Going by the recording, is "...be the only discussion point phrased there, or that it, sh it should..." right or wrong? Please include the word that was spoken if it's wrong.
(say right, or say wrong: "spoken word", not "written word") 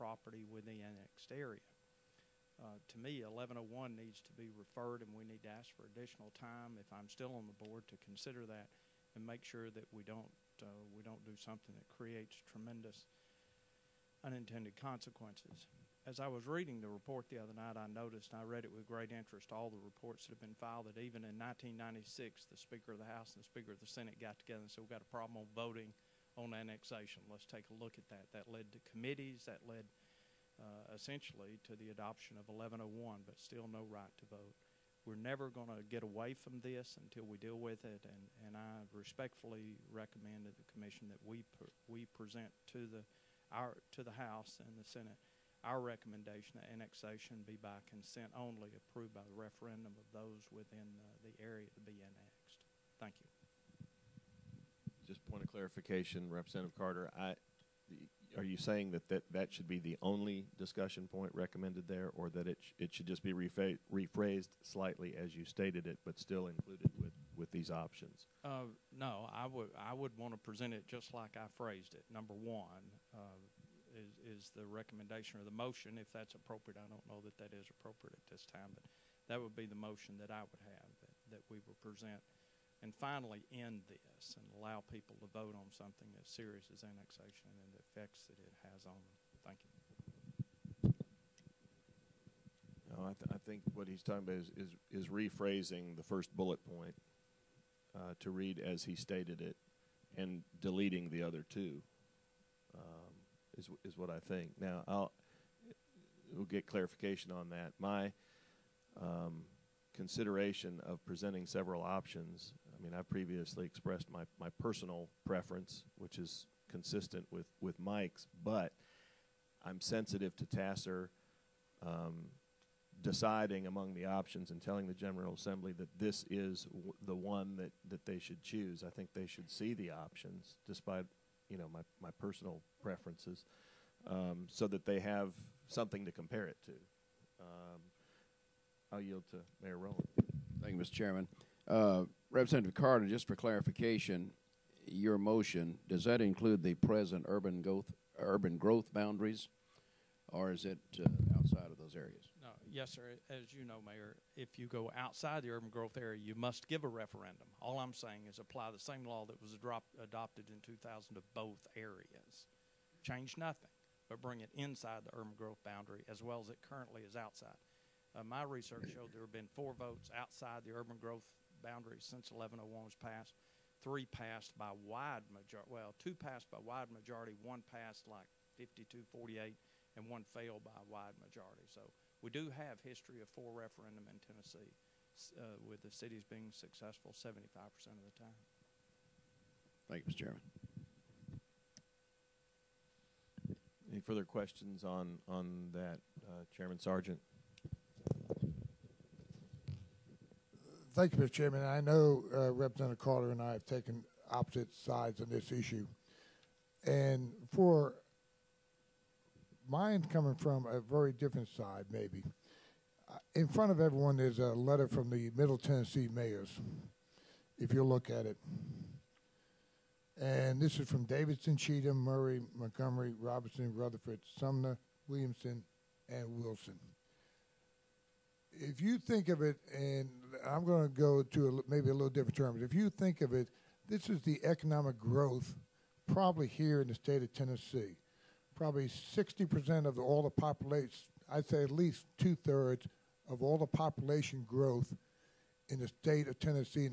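wrong: "recommended", not "phrased".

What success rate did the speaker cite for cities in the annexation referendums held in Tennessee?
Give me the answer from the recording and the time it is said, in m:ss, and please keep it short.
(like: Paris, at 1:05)
75%, at 3:07.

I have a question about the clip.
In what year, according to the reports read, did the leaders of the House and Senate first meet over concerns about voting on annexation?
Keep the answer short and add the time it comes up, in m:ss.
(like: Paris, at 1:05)
1996, at 0:21.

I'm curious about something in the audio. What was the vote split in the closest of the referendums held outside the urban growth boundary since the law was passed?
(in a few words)
52-48.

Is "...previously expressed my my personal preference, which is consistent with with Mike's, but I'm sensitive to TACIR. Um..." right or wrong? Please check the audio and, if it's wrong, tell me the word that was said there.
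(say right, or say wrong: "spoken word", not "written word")
right.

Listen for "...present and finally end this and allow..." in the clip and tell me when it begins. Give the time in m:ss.
1:21.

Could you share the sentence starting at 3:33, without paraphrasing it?
Uh, in front of everyone, there's a letter from the Middle Tennessee mayors, if you look at it.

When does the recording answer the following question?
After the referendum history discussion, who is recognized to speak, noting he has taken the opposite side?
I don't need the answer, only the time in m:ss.
3:16.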